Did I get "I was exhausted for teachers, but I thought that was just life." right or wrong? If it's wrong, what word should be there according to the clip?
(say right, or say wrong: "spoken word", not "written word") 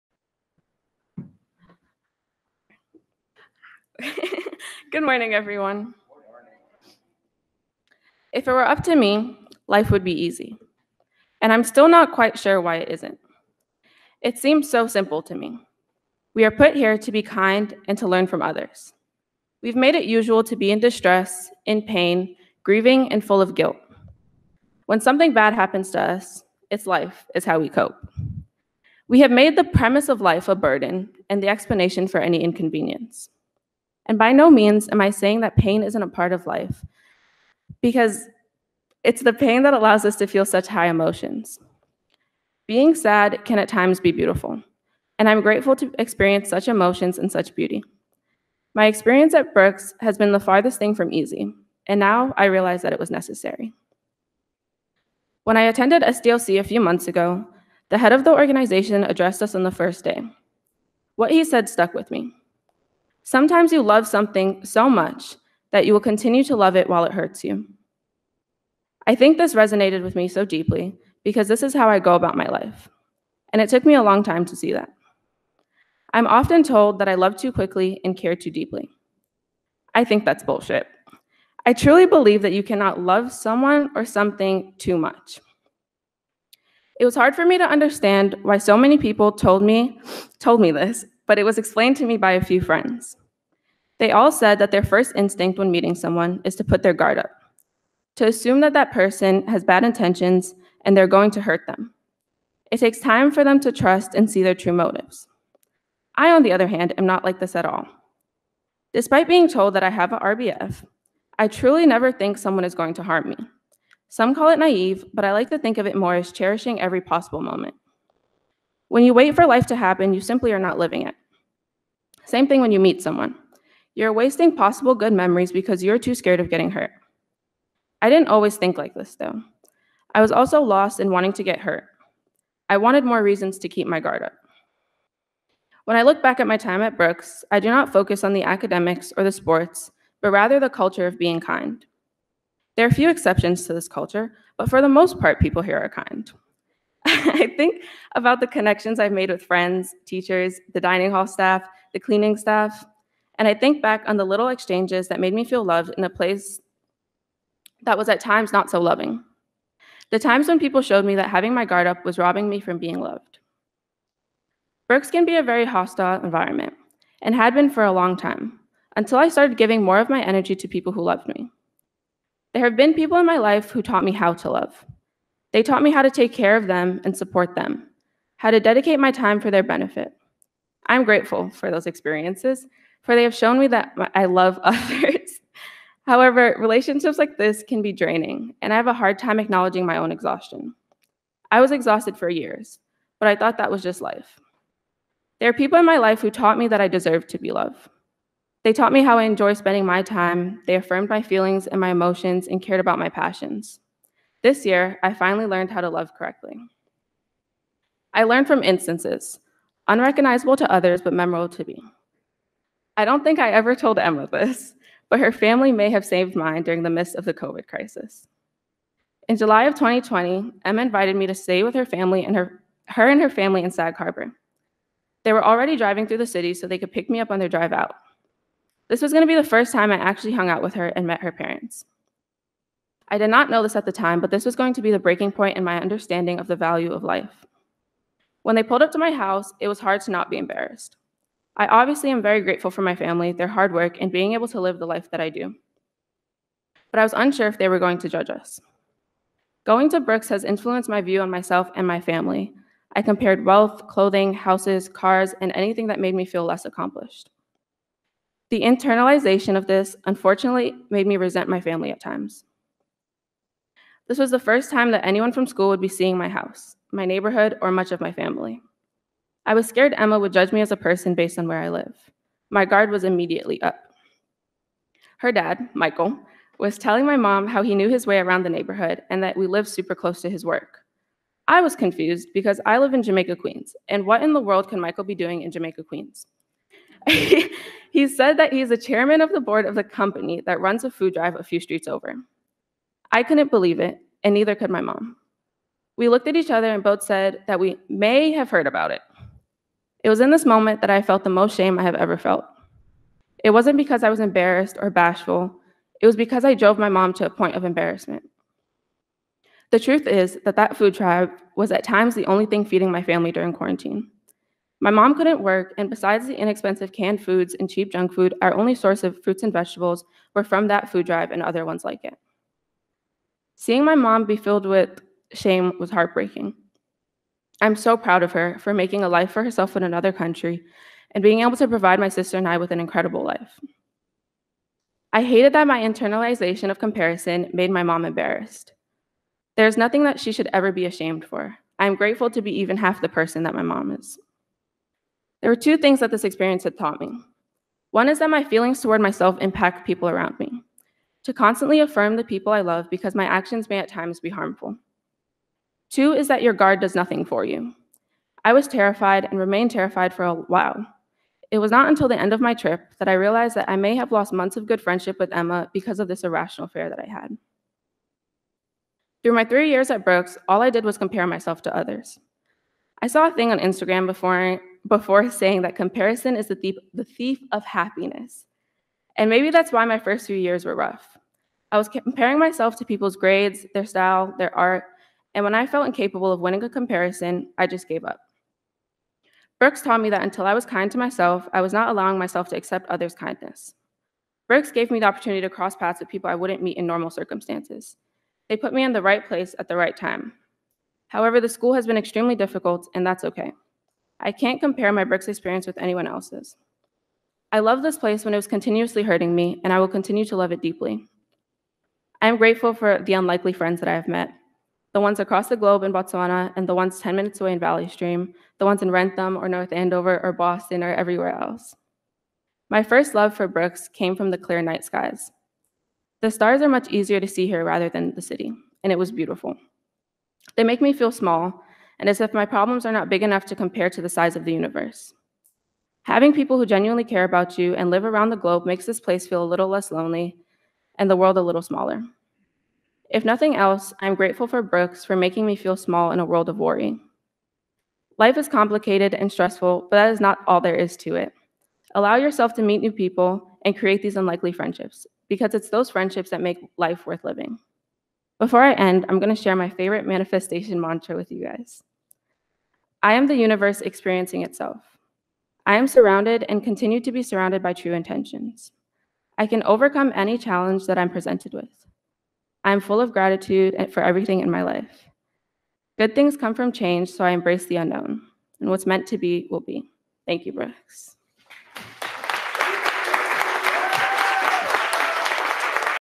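wrong: "years", not "teachers".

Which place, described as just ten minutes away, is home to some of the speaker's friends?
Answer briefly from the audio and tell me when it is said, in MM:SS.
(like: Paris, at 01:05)
Valley Stream, at 06:57.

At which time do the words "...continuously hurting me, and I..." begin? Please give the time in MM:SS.
06:48.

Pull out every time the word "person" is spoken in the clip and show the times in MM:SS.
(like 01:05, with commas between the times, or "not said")
01:38, 04:30, 05:43.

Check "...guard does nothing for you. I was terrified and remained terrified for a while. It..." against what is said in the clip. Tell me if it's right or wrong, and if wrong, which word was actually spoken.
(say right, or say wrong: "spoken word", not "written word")
right.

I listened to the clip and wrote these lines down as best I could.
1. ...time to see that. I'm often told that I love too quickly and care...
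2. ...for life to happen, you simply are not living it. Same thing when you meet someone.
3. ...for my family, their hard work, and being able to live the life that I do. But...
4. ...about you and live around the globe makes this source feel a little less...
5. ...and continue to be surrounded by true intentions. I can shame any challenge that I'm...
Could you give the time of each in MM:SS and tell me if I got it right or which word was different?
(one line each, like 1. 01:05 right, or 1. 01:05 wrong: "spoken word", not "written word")
1. 01:14 right
2. 01:59 right
3. 04:02 right
4. 07:17 wrong: "place", not "source"
5. 07:46 wrong: "overcome", not "shame".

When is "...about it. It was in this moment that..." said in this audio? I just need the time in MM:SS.
04:58.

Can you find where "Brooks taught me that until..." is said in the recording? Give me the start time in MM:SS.
06:29.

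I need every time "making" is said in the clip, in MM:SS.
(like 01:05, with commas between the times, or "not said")
05:28, 07:25.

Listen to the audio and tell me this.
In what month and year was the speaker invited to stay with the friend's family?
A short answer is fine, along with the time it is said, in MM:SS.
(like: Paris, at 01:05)
July 2020, at 03:39.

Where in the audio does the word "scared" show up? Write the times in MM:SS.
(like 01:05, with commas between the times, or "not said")
02:06, 04:29.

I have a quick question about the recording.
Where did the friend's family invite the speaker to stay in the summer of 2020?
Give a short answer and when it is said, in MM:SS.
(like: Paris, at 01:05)
Sag Harbor, at 03:43.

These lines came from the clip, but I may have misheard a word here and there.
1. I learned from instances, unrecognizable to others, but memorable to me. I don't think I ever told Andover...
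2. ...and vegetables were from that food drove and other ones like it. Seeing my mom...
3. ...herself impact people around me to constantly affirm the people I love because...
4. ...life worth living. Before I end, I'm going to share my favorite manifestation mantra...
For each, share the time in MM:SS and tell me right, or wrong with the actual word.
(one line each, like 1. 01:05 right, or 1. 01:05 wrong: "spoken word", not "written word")
1. 03:28 wrong: "Emma", not "Andover"
2. 05:19 wrong: "drive", not "drove"
3. 05:49 wrong: "myself", not "herself"
4. 07:36 right.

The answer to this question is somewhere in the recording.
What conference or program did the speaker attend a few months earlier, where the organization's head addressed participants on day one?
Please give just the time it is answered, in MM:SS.
00:56.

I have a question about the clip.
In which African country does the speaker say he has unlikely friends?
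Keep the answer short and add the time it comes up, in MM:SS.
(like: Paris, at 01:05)
Botswana, at 06:55.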